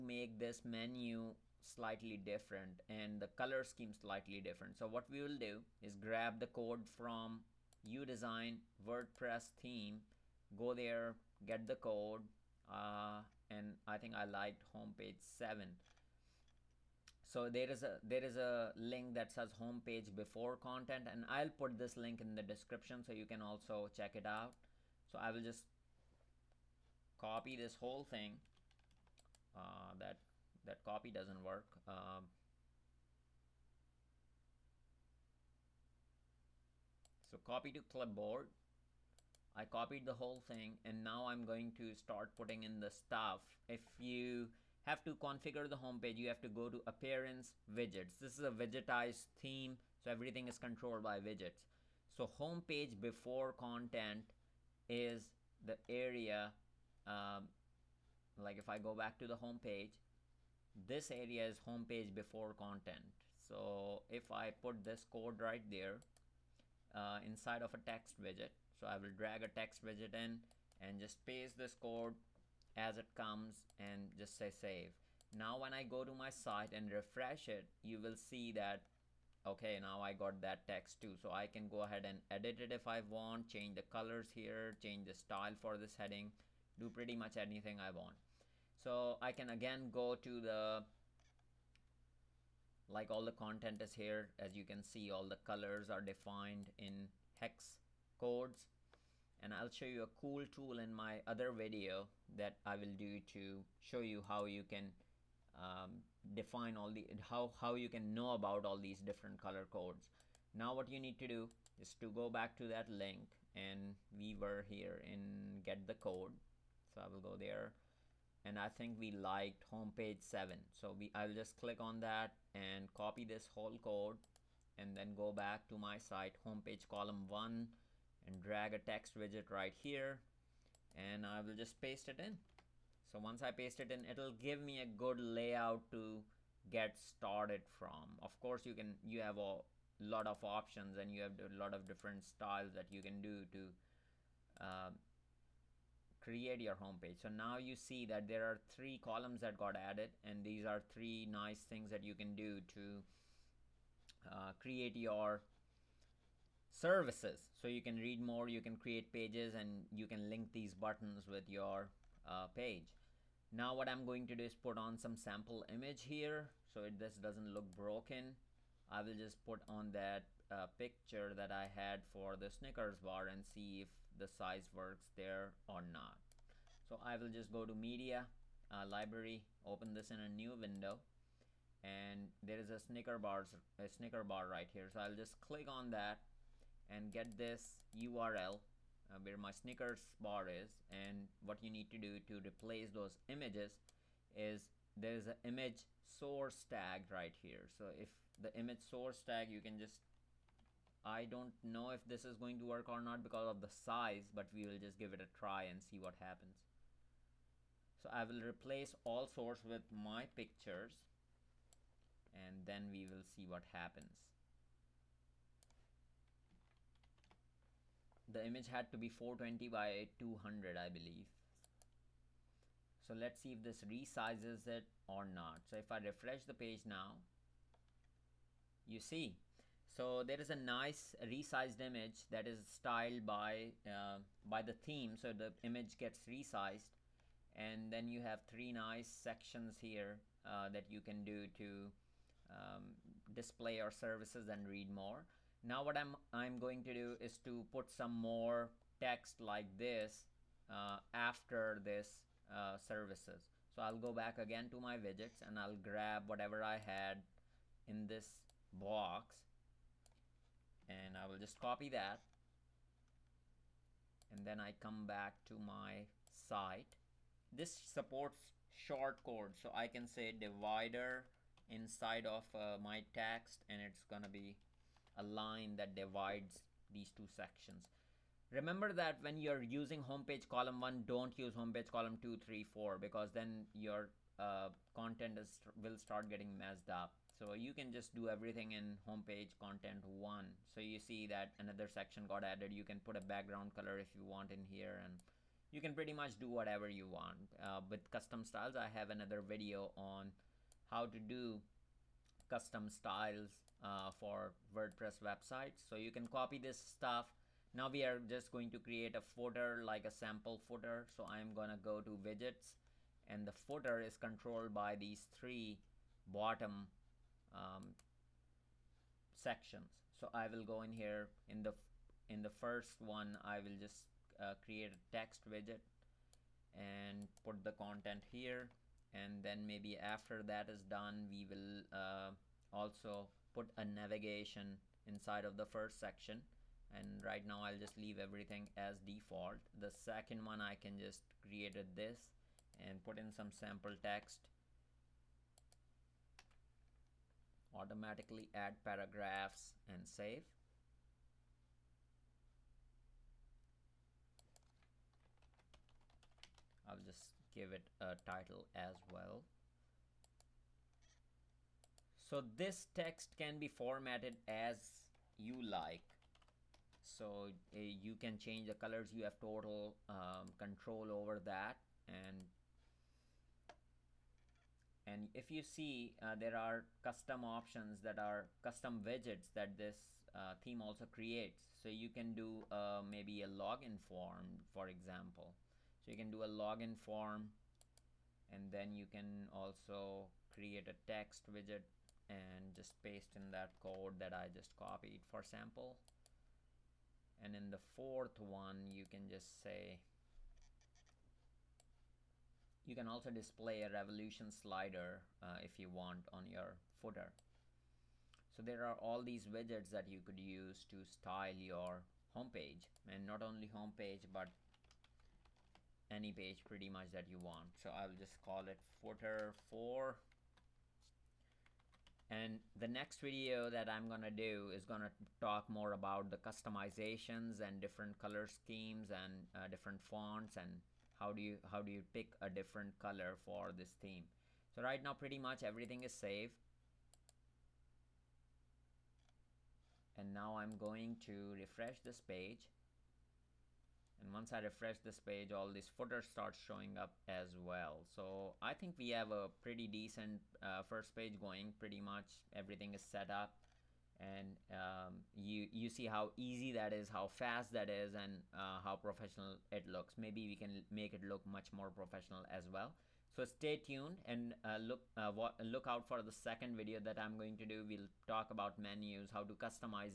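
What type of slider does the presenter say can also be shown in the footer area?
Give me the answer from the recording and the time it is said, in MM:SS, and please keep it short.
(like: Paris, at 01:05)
Revolution slider, at 06:43.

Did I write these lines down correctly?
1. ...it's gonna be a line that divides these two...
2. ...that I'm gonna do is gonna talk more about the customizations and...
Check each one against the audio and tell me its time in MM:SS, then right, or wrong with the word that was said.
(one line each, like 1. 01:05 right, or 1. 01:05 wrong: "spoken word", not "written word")
1. 04:33 right
2. 07:03 right.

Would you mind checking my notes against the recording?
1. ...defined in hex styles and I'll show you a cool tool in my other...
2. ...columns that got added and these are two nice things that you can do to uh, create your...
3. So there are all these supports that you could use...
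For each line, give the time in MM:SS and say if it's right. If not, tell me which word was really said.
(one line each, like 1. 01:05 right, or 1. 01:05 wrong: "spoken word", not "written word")
1. 01:36 wrong: "codes", not "styles"
2. 02:28 wrong: "three", not "two"
3. 06:48 wrong: "widgets", not "supports".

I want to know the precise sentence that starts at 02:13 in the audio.
So once I paste it in, it'll give me a good layout to get started from.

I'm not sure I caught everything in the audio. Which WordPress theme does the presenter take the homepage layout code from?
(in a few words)
UDesign.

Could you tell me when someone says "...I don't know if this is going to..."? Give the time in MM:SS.
03:21.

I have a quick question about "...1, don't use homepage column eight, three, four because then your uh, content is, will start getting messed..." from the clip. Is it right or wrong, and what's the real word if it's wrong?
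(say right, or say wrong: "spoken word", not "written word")
wrong: "two", not "eight".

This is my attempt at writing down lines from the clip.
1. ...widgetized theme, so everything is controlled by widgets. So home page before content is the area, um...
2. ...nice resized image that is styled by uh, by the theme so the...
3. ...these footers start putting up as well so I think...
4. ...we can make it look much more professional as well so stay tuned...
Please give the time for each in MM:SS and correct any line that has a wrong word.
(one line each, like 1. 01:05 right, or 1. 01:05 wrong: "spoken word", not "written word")
1. 00:48 right
2. 03:50 right
3. 07:25 wrong: "showing", not "putting"
4. 07:40 right.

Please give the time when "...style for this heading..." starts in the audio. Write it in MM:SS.
01:25.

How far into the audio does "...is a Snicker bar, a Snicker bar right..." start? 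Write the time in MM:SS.
03:02.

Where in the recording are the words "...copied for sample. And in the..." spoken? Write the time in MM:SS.
06:34.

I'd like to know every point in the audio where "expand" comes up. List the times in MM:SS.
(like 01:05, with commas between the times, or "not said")
not said.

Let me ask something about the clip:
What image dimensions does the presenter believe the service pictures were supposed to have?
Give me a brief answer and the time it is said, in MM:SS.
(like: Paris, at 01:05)
420 by 200, at 03:39.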